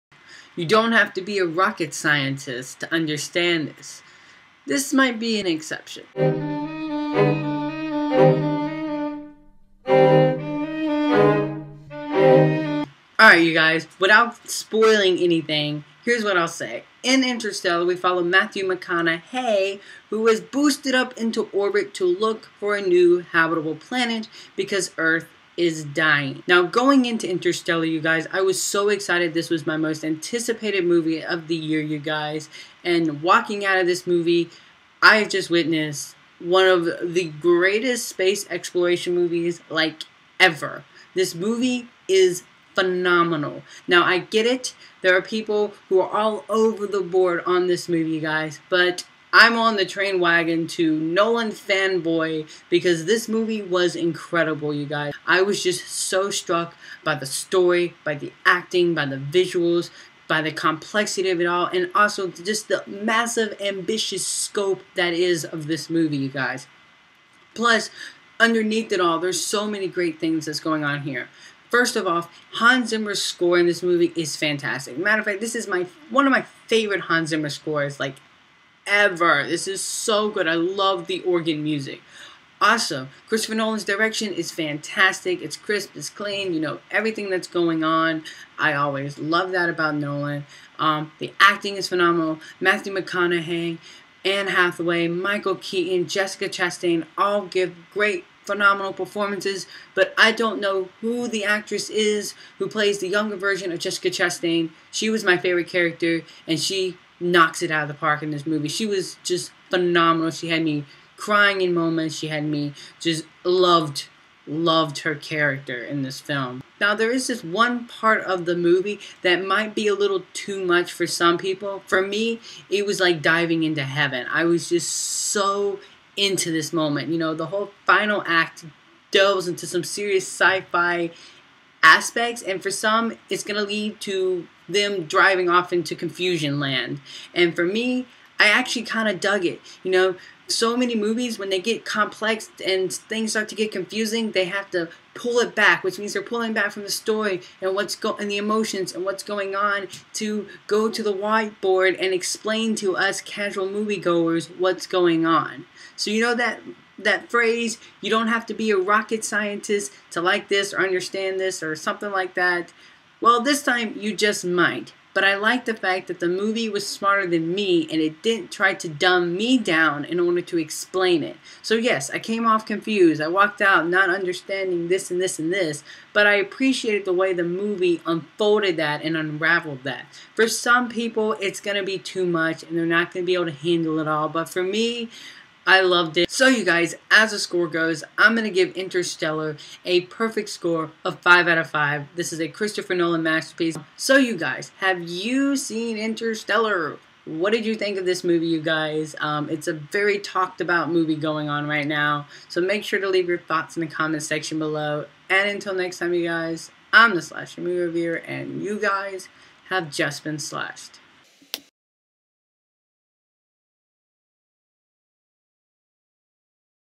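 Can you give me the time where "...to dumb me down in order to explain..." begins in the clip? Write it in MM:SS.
02:48.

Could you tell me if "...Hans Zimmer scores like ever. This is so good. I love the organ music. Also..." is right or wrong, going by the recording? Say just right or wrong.
right.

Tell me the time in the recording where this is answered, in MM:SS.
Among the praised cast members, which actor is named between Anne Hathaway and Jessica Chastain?
01:35.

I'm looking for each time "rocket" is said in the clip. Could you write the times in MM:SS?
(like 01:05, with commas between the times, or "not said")
00:01, 02:38.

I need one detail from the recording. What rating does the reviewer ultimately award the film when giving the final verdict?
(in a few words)
5 out of 5.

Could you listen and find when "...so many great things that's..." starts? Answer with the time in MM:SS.
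01:09.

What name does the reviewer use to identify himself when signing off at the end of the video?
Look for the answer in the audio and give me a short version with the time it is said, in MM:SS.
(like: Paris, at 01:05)
the Slasher Movie Reviewer, at 03:27.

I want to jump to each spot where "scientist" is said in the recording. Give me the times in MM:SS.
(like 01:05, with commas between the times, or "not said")
00:01, 02:39.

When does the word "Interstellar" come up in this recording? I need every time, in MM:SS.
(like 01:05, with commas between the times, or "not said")
00:17, 00:27, 03:08, 03:15.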